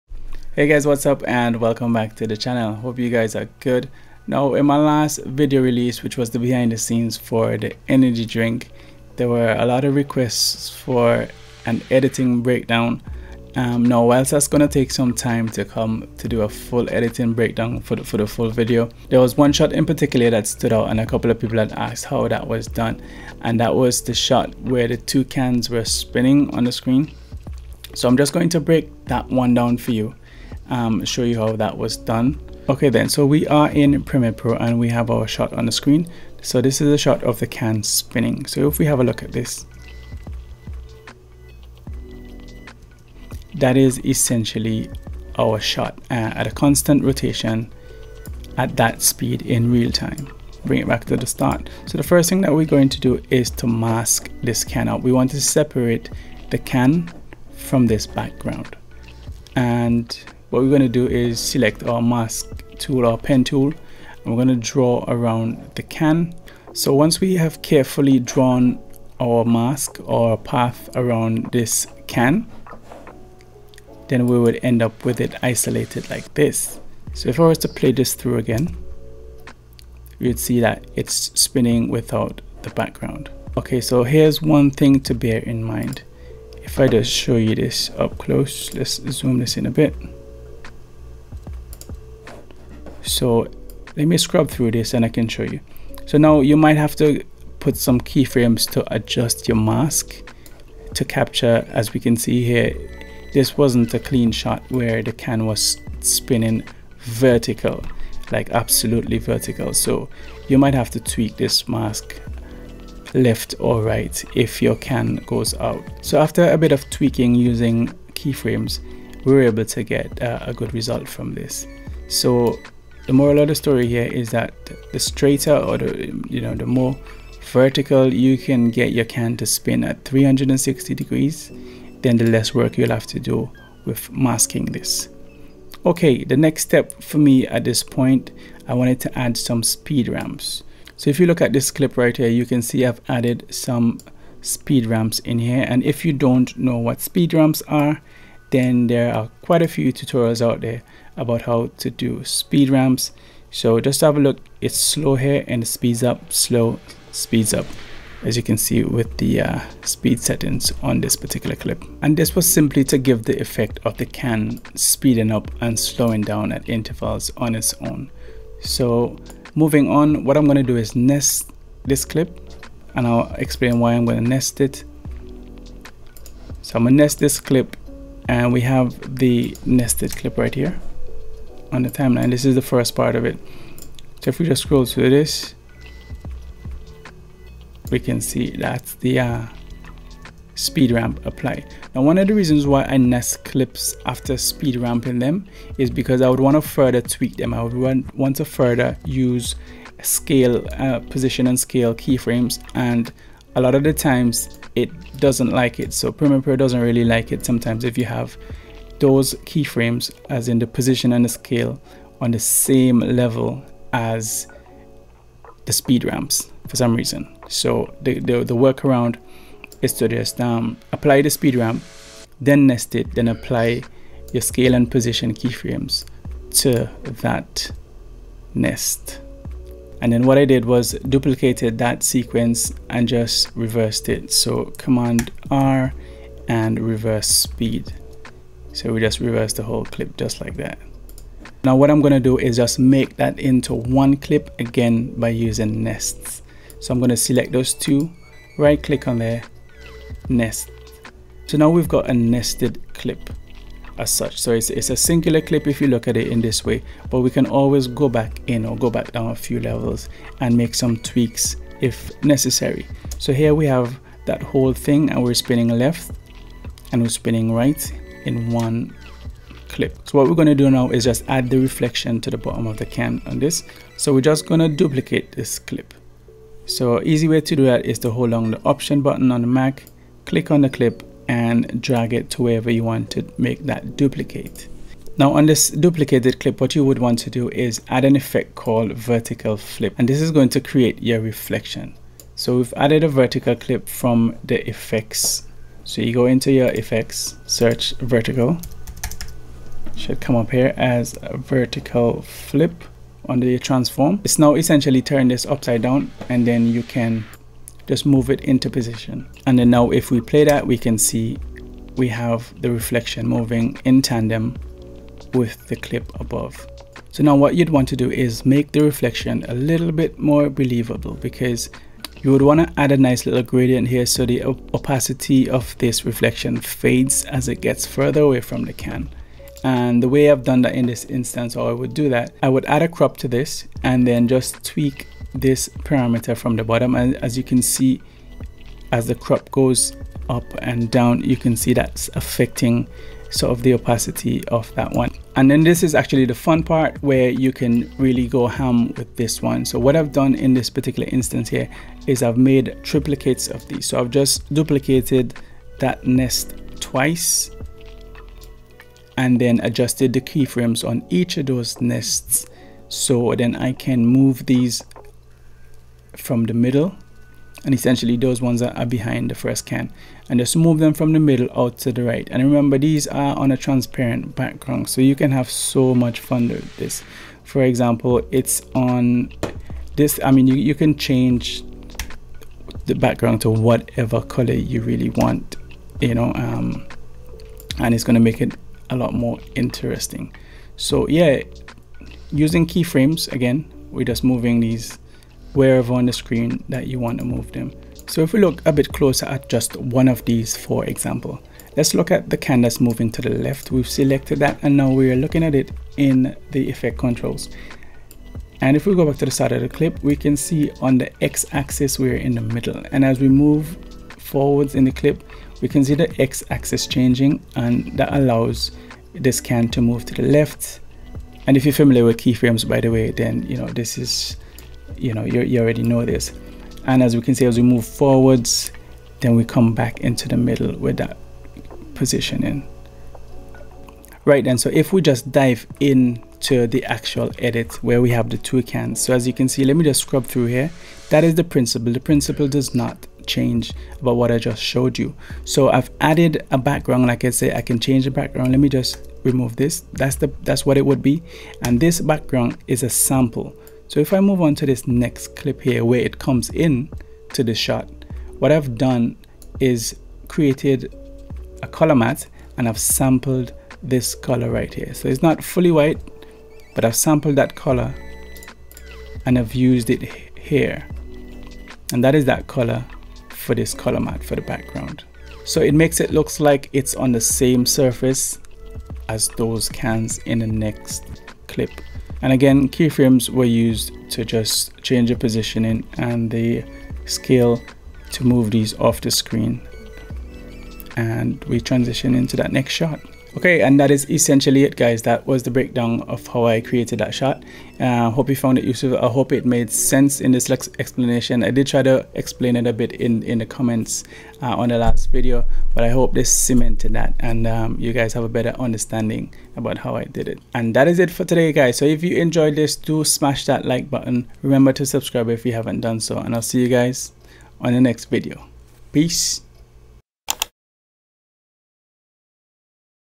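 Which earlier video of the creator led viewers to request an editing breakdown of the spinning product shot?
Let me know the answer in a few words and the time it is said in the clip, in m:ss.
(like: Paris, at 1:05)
Behind the scenes for the energy drink, at 0:06.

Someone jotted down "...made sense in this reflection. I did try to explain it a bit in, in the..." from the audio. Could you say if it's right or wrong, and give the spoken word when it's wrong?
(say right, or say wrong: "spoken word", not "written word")
wrong: "explanation", not "reflection".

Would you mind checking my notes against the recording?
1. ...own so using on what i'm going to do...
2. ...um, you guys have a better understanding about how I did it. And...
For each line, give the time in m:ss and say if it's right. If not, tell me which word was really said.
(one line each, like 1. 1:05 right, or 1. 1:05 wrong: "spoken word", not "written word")
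1. 2:47 wrong: "moving", not "using"
2. 8:27 right.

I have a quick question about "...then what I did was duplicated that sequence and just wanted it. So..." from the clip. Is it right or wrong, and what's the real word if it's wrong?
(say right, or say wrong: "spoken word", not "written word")
wrong: "reversed", not "wanted".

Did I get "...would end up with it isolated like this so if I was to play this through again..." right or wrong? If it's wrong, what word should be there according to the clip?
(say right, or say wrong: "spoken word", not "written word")
right.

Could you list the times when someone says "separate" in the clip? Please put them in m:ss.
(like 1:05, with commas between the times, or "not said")
0:55.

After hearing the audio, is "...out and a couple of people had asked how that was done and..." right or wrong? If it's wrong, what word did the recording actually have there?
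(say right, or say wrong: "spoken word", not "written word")
right.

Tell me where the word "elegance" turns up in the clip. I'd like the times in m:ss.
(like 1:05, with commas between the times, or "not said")
not said.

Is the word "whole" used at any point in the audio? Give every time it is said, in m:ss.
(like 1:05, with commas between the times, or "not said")
3:59, 4:24.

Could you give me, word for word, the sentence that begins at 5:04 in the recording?
It's now essentially turn this upside down and then you can just move it into position.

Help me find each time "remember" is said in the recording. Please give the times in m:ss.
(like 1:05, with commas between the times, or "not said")
6:12, 8:34.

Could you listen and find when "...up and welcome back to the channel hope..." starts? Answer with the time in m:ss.
0:01.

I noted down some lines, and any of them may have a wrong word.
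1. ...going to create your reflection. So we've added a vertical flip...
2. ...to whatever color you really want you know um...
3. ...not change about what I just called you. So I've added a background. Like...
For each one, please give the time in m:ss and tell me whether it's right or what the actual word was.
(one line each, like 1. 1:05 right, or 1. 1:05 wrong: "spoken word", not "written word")
1. 4:50 right
2. 6:23 right
3. 7:22 wrong: "showed", not "called".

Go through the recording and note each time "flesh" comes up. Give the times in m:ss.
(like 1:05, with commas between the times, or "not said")
not said.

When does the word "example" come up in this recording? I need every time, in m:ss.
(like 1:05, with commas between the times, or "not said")
6:17, 6:40.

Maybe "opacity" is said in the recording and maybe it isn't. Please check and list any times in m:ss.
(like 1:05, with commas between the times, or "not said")
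5:24, 5:43.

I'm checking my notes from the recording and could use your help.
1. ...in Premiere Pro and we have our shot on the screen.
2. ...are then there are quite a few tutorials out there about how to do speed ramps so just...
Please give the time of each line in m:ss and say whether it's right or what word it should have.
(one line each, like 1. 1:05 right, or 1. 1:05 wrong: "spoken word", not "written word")
1. 0:33 right
2. 2:27 right.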